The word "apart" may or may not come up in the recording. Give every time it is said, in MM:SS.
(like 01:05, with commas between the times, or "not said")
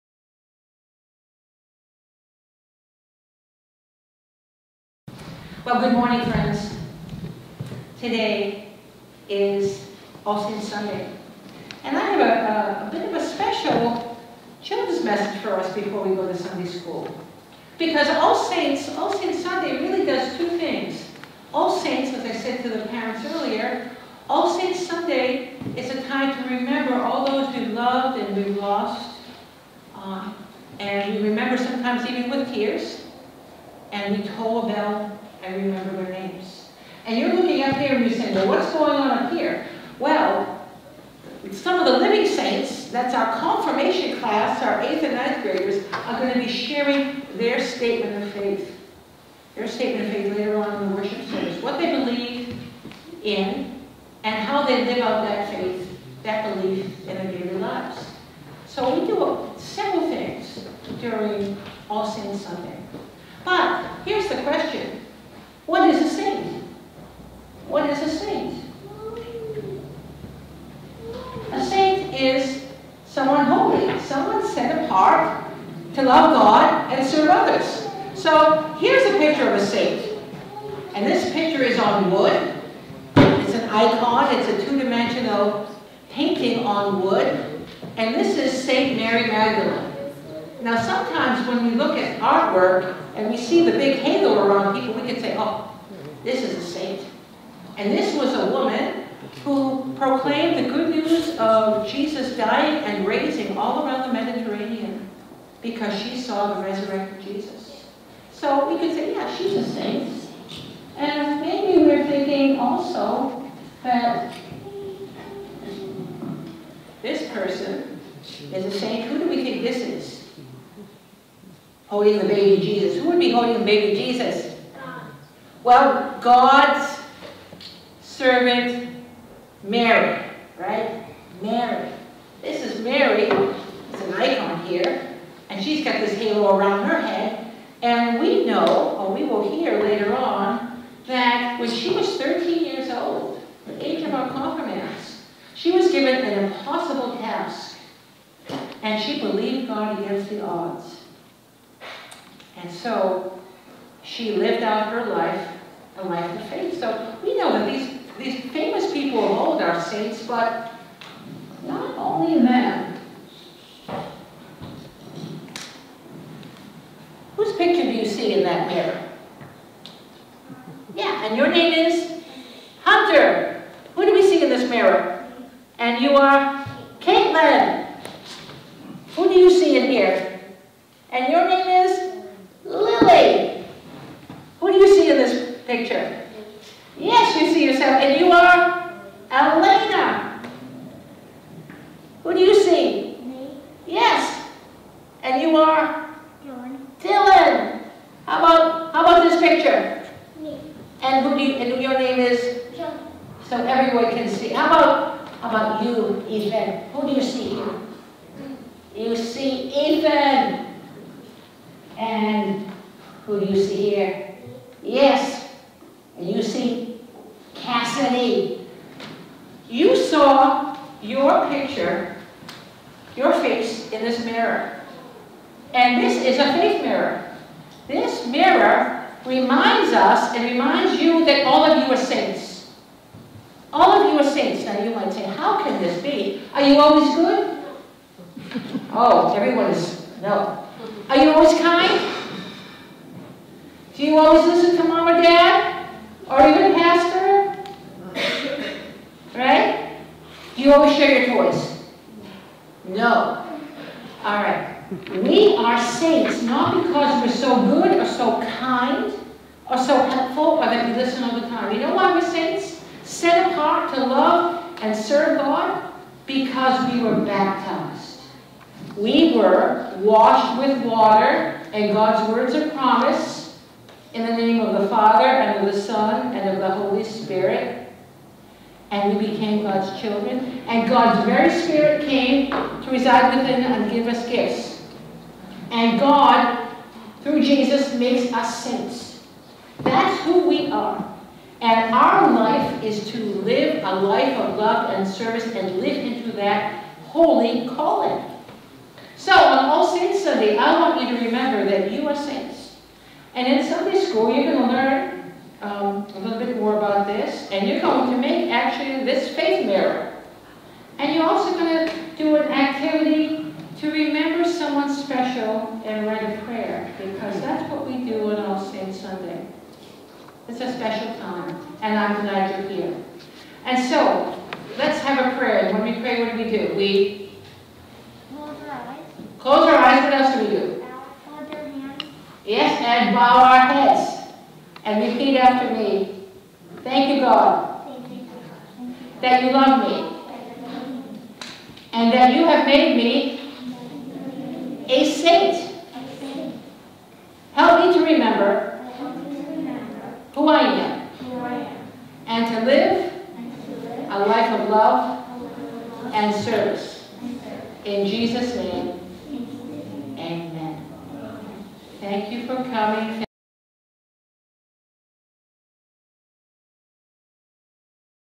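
01:14, 04:23.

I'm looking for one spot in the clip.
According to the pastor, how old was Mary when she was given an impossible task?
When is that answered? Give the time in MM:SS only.
02:22.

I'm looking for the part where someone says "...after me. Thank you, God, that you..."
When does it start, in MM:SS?
05:35.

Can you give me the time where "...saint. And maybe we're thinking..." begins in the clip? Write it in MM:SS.
01:49.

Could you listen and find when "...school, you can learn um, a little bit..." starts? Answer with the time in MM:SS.
05:03.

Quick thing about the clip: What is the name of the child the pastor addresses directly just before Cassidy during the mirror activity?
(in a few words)
Ethan.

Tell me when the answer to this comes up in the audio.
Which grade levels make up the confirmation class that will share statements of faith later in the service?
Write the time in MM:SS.
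00:44.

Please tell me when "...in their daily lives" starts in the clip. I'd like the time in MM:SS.
00:57.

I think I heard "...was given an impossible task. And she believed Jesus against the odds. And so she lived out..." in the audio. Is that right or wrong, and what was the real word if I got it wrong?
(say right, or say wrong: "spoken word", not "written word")
wrong: "God", not "Jesus".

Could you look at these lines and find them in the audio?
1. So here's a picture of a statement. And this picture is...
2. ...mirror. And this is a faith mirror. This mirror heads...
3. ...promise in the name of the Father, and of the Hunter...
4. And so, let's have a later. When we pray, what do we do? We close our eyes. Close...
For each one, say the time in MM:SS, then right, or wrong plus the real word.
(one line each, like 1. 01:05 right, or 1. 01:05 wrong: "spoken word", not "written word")
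1. 01:18 wrong: "saint", not "statement"
2. 03:44 wrong: "reminds", not "heads"
3. 04:32 wrong: "Son", not "Hunter"
4. 05:23 wrong: "prayer", not "later".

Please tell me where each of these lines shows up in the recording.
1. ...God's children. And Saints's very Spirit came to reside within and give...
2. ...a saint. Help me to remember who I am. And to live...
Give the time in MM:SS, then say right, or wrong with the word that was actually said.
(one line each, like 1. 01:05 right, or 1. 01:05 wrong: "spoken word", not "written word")
1. 04:39 wrong: "God", not "Saints"
2. 05:44 right.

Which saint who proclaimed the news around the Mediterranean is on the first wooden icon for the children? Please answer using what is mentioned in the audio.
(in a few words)
Mary Magdalene.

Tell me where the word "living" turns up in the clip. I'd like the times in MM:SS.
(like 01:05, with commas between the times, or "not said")
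00:41.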